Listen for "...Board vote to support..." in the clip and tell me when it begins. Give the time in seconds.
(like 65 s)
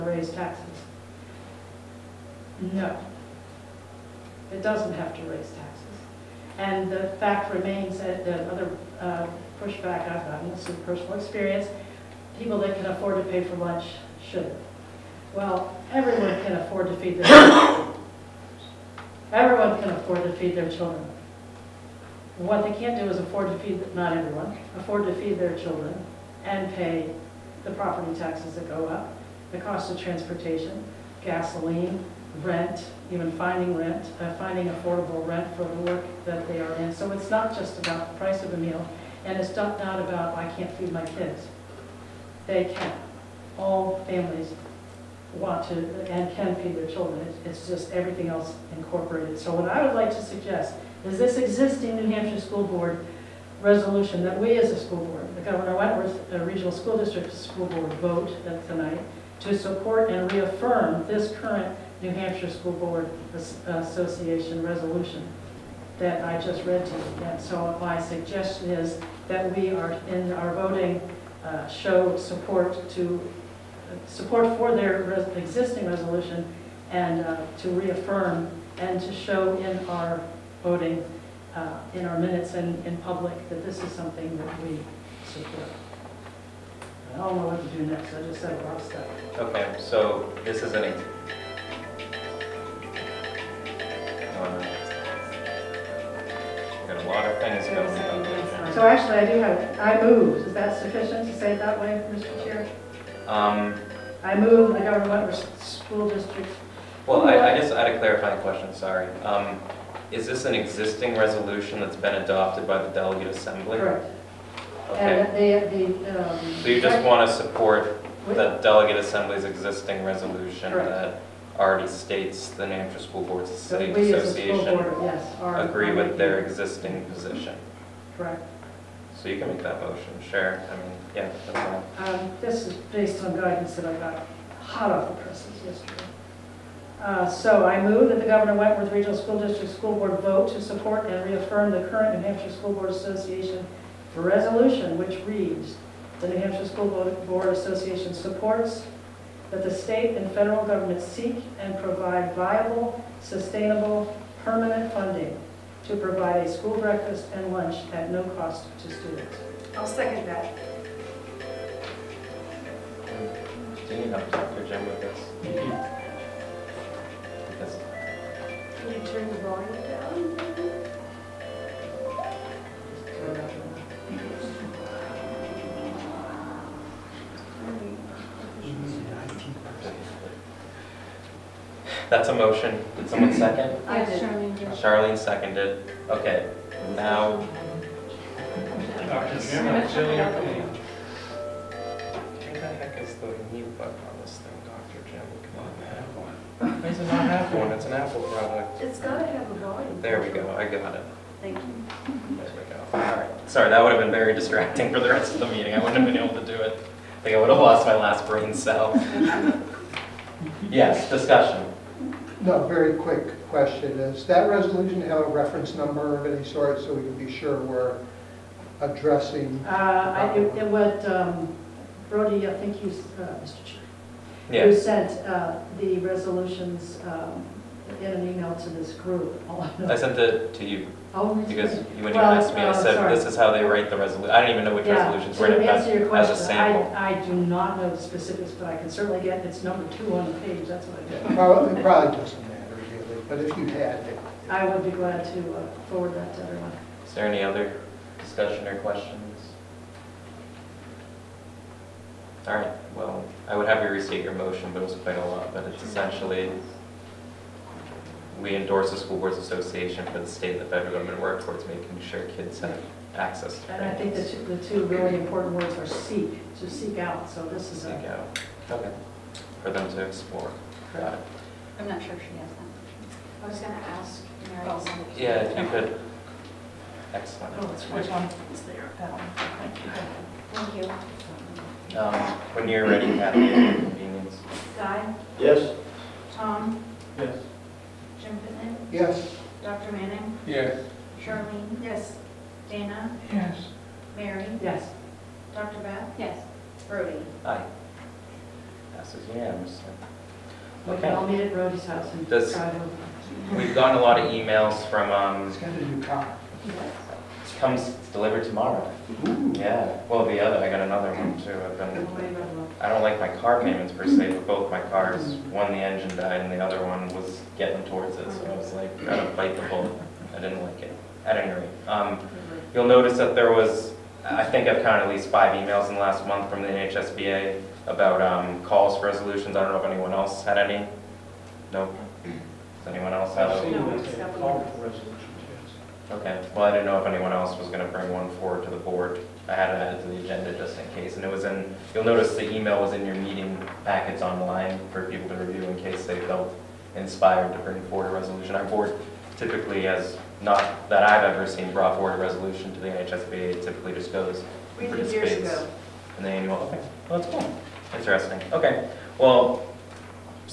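139 s.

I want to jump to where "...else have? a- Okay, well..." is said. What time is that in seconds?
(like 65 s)
333 s.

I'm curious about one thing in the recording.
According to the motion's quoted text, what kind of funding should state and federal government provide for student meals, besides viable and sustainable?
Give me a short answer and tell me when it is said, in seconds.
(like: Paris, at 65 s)
permanent, at 154 s.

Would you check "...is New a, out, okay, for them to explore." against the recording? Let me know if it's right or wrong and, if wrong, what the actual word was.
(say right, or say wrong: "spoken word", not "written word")
wrong: "Seek", not "New".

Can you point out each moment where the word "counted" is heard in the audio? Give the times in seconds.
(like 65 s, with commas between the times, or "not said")
324 s.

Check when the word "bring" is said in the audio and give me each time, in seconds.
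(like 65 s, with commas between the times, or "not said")
337 s, 347 s.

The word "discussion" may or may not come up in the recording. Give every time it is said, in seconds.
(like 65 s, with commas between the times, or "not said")
211 s, 248 s.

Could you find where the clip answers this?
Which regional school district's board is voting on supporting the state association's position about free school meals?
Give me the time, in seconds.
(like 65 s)
55 s.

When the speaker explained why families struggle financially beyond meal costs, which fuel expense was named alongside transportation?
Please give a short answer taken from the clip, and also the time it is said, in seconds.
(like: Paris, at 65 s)
gasoline, at 31 s.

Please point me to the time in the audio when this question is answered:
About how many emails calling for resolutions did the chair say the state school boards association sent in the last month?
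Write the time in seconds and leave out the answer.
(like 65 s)
325 s.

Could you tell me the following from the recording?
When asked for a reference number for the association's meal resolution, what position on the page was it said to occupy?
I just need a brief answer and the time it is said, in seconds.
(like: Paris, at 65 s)
number two, at 239 s.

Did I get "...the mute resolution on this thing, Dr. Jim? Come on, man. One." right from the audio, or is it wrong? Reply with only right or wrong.
wrong.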